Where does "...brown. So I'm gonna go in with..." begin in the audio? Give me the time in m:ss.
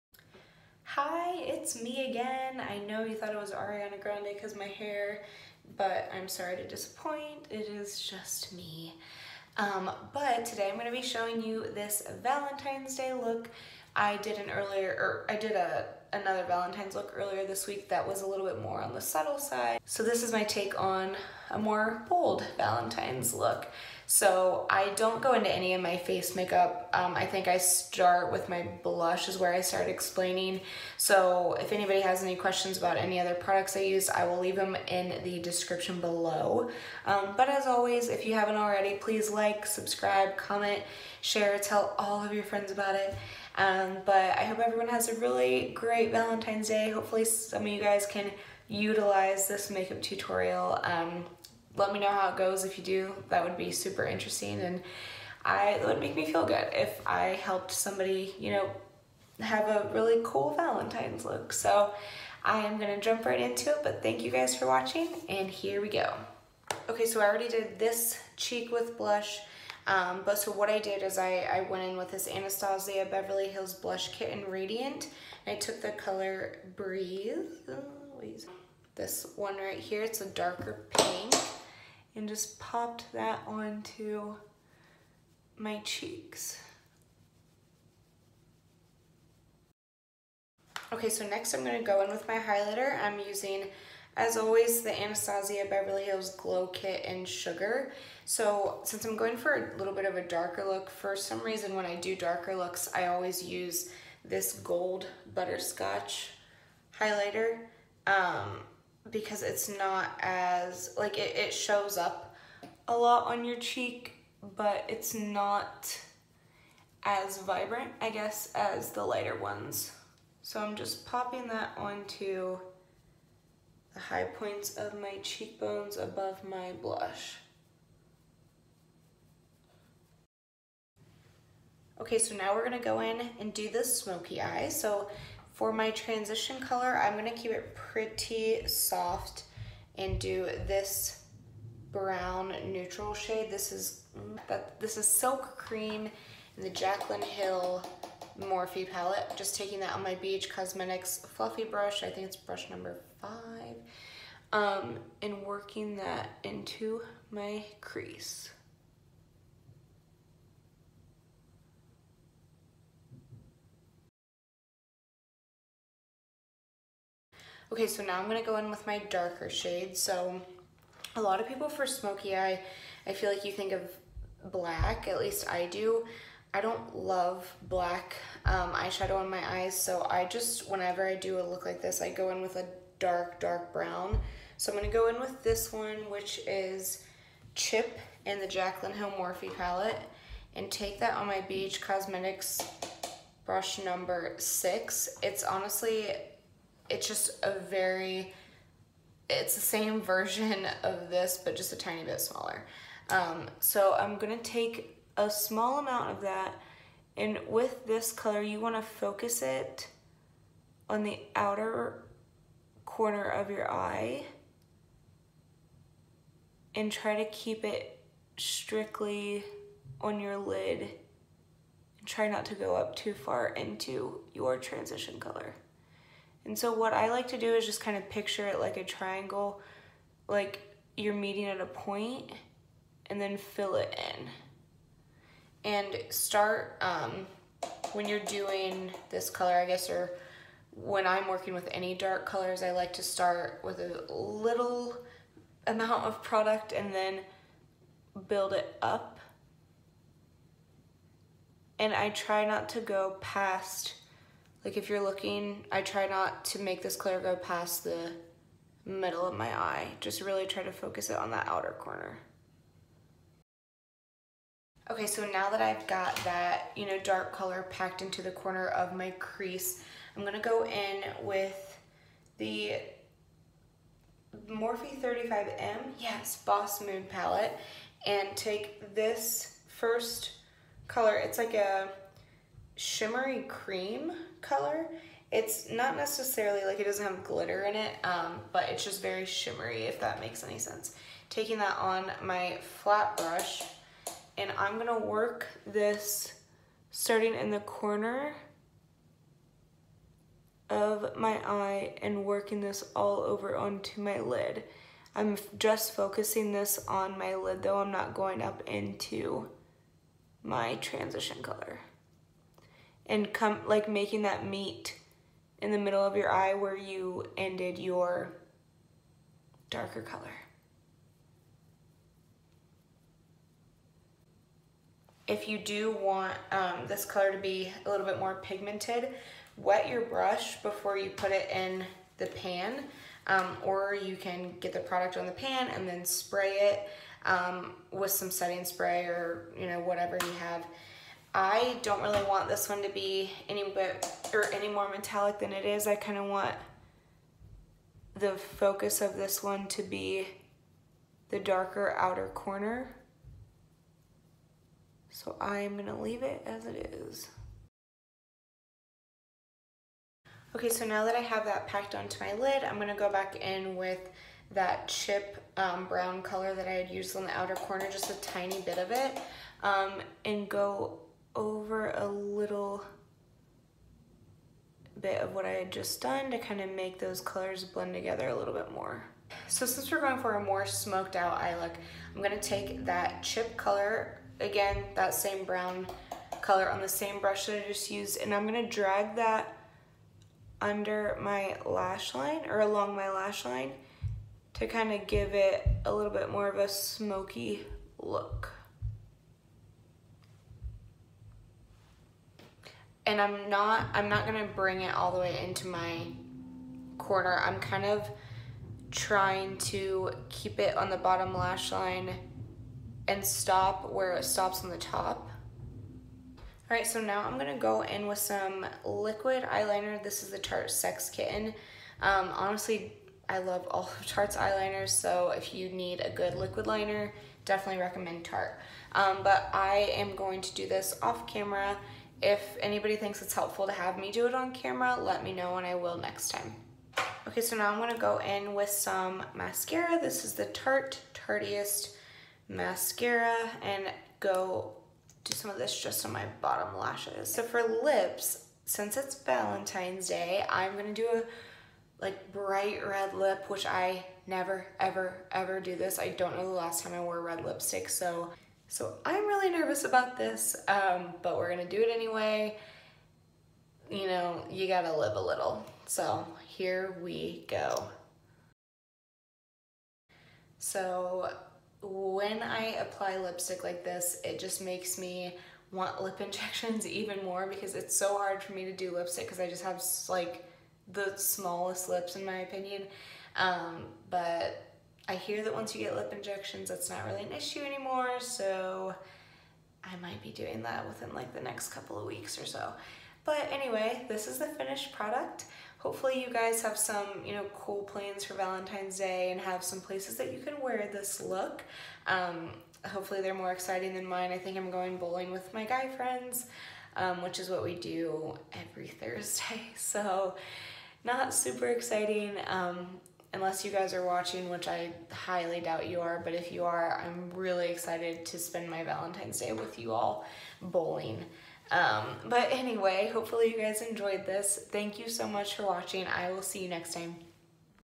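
3:03.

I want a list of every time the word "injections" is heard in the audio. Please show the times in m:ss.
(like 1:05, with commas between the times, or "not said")
7:56, 8:06.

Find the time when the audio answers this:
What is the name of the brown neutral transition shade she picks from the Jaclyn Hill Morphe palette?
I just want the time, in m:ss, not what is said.
2:25.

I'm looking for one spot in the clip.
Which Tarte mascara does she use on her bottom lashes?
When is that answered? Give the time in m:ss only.
7:21.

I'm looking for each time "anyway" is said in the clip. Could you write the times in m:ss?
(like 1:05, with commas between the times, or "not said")
7:41, 8:13, 8:42.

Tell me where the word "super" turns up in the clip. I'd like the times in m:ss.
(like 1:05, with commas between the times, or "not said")
0:53, 8:31.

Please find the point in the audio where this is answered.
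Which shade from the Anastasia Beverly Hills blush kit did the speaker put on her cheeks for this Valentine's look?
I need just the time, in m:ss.
1:16.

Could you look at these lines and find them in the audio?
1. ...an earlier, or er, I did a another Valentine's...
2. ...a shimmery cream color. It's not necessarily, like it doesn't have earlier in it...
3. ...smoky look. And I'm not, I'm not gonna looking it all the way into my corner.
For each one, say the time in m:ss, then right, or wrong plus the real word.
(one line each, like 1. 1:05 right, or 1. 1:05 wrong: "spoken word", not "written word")
1. 0:14 right
2. 4:41 wrong: "glitter", not "earlier"
3. 6:36 wrong: "bring", not "looking".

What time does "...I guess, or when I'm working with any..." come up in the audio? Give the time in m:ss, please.
3:59.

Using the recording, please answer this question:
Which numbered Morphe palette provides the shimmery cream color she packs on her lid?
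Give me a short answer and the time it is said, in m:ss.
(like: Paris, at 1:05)
35M, at 4:35.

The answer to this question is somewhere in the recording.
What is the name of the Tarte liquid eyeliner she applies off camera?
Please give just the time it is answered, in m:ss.
7:00.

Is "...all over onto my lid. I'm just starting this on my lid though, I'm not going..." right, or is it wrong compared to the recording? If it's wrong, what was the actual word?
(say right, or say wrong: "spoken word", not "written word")
wrong: "focusing", not "starting".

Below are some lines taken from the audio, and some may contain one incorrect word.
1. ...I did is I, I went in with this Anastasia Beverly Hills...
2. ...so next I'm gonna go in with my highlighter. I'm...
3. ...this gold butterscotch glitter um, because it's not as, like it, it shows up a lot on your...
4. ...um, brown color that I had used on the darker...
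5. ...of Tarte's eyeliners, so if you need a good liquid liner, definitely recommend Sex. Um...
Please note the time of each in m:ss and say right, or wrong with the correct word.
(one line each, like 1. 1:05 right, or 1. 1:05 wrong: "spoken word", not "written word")
1. 1:10 right
2. 1:31 right
3. 1:44 wrong: "highlighter", not "glitter"
4. 6:05 wrong: "outer", not "darker"
5. 7:03 wrong: "Tarte", not "Sex".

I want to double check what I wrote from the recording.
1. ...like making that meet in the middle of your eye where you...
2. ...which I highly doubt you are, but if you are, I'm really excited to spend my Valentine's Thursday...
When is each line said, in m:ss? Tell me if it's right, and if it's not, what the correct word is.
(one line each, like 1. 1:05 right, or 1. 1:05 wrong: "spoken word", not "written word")
1. 5:13 right
2. 8:34 wrong: "Day", not "Thursday".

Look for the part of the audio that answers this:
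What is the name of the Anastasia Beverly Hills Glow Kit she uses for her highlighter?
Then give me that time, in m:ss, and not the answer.
1:37.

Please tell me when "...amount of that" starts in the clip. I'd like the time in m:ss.
3:25.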